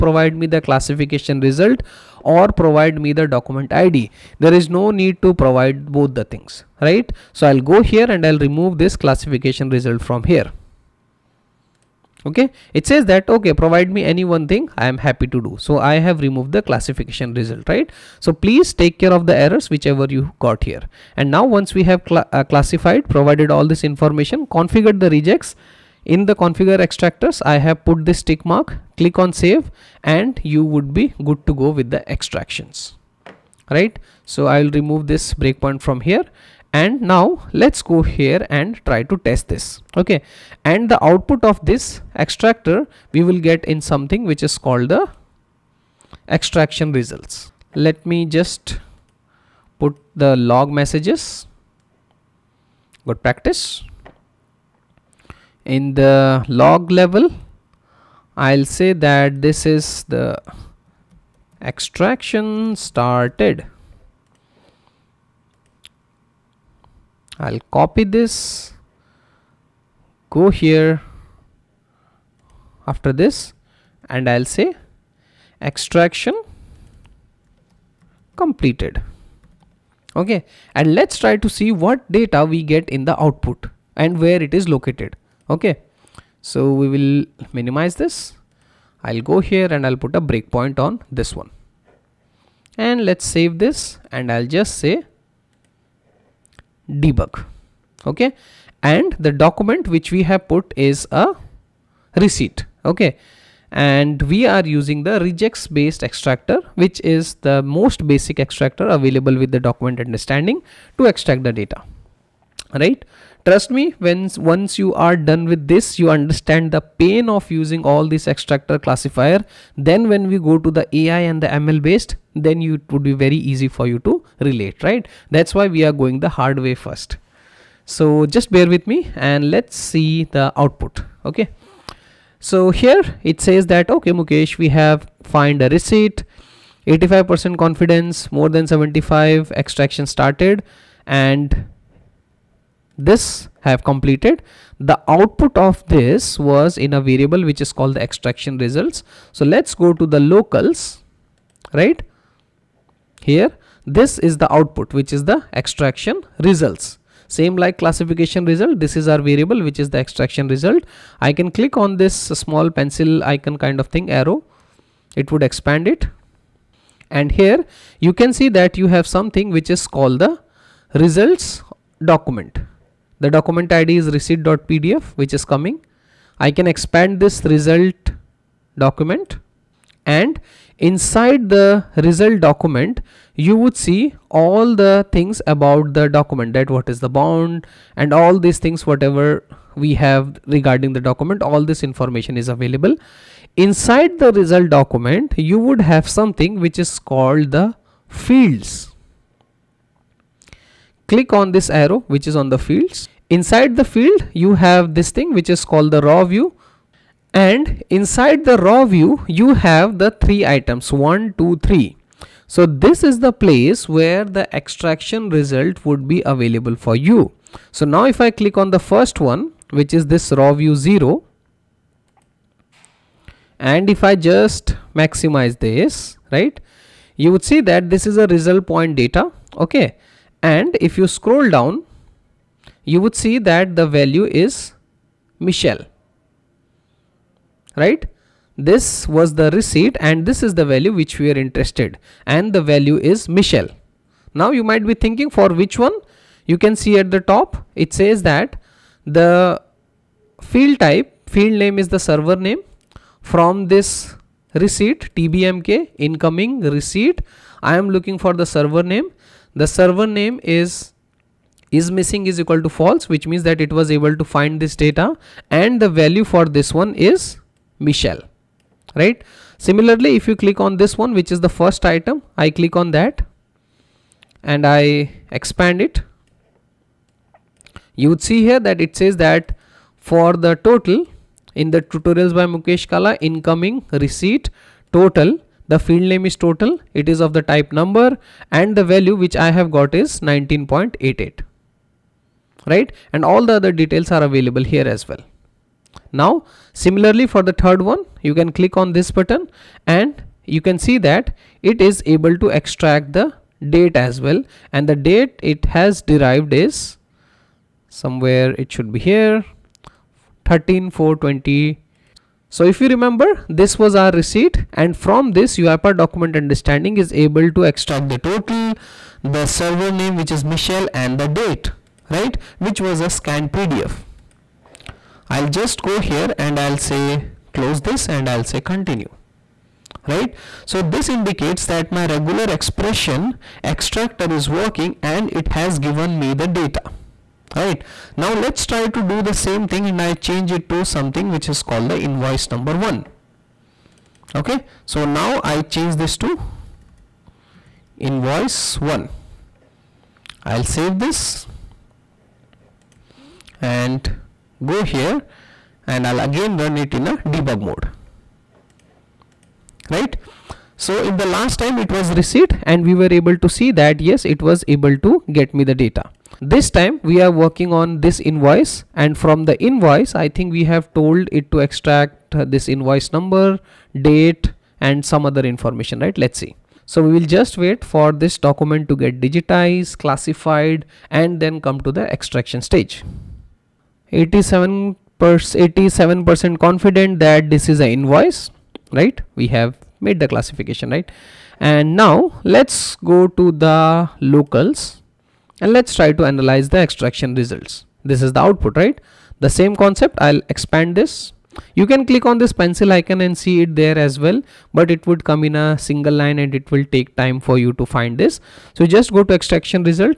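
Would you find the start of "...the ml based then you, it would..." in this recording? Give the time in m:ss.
2:01.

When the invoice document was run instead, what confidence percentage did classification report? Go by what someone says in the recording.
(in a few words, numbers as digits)
87%.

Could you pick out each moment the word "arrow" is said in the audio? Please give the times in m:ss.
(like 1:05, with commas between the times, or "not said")
2:44, 3:21.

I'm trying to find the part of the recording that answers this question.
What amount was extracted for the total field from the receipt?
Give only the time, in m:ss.
4:50.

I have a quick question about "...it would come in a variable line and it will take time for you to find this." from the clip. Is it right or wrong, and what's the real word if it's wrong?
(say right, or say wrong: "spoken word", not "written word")
wrong: "single", not "variable".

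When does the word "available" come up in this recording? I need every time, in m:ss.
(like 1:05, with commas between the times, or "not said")
1:48, 3:12, 3:36, 4:54.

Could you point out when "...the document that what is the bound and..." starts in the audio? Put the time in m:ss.
3:05.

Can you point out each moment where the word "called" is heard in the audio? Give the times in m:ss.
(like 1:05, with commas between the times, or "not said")
0:44, 2:27, 2:49, 3:17, 3:25, 5:41.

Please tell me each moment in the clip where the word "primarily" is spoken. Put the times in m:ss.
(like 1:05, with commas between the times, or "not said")
not said.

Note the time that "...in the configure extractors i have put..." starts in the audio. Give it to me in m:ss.
0:26.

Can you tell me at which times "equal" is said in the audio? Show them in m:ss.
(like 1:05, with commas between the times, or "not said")
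4:22.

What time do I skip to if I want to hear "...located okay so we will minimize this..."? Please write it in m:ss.
1:24.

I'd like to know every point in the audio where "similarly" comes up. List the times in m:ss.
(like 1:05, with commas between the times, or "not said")
4:29, 4:56.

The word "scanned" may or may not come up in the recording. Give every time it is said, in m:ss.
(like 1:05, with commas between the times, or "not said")
5:23.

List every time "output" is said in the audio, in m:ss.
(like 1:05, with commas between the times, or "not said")
0:41, 1:23, 2:10, 2:25, 2:34, 6:38.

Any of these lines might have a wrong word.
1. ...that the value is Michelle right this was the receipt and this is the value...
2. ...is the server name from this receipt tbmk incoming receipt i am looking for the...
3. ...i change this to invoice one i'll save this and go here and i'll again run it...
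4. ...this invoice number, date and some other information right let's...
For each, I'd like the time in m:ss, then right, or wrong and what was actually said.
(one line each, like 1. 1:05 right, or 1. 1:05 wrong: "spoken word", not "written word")
1. 3:53 right
2. 4:11 right
3. 5:45 right
4. 6:12 right.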